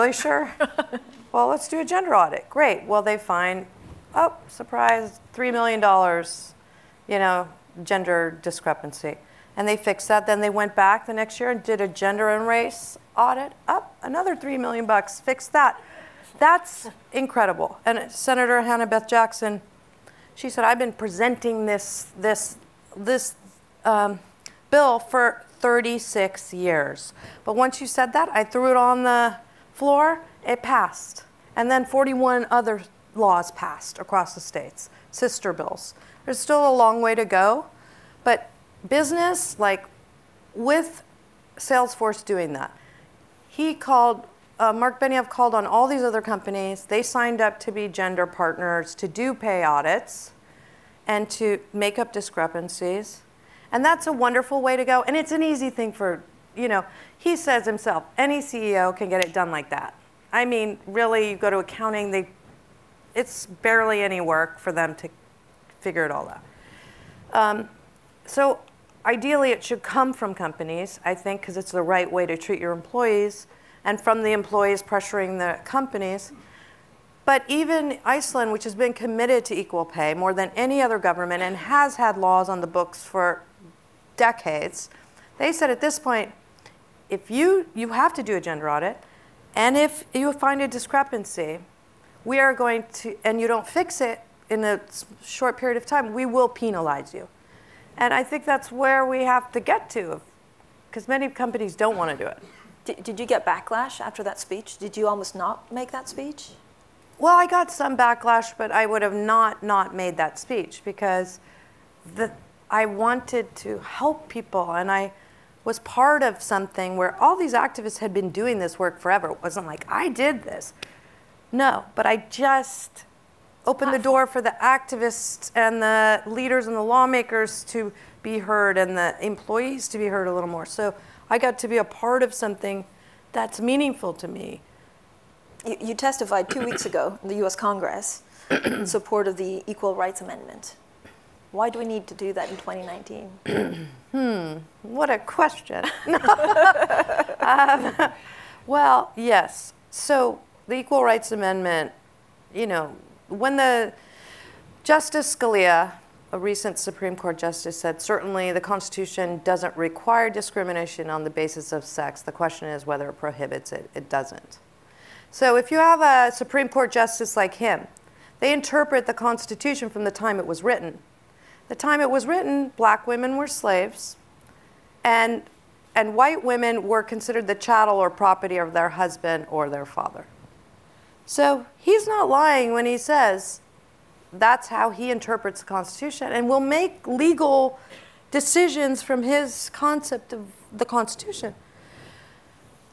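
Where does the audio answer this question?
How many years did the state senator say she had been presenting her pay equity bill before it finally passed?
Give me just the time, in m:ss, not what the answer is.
0:25.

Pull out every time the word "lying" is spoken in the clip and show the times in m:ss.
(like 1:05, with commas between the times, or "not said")
3:02.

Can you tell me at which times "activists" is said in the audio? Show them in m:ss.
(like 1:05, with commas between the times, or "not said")
1:57, 2:04.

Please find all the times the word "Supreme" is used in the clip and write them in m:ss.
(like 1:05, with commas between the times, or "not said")
2:36, 2:46.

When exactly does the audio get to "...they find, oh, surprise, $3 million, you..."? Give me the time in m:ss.
0:03.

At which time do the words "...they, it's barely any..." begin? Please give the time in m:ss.
1:02.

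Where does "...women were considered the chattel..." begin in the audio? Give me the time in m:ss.
2:56.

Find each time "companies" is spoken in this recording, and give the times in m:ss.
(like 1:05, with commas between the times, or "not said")
0:46, 1:10, 1:15, 1:41.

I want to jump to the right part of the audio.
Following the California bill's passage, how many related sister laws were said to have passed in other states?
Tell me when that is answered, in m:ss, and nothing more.
0:31.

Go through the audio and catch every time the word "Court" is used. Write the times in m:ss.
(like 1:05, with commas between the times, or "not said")
2:37, 2:46.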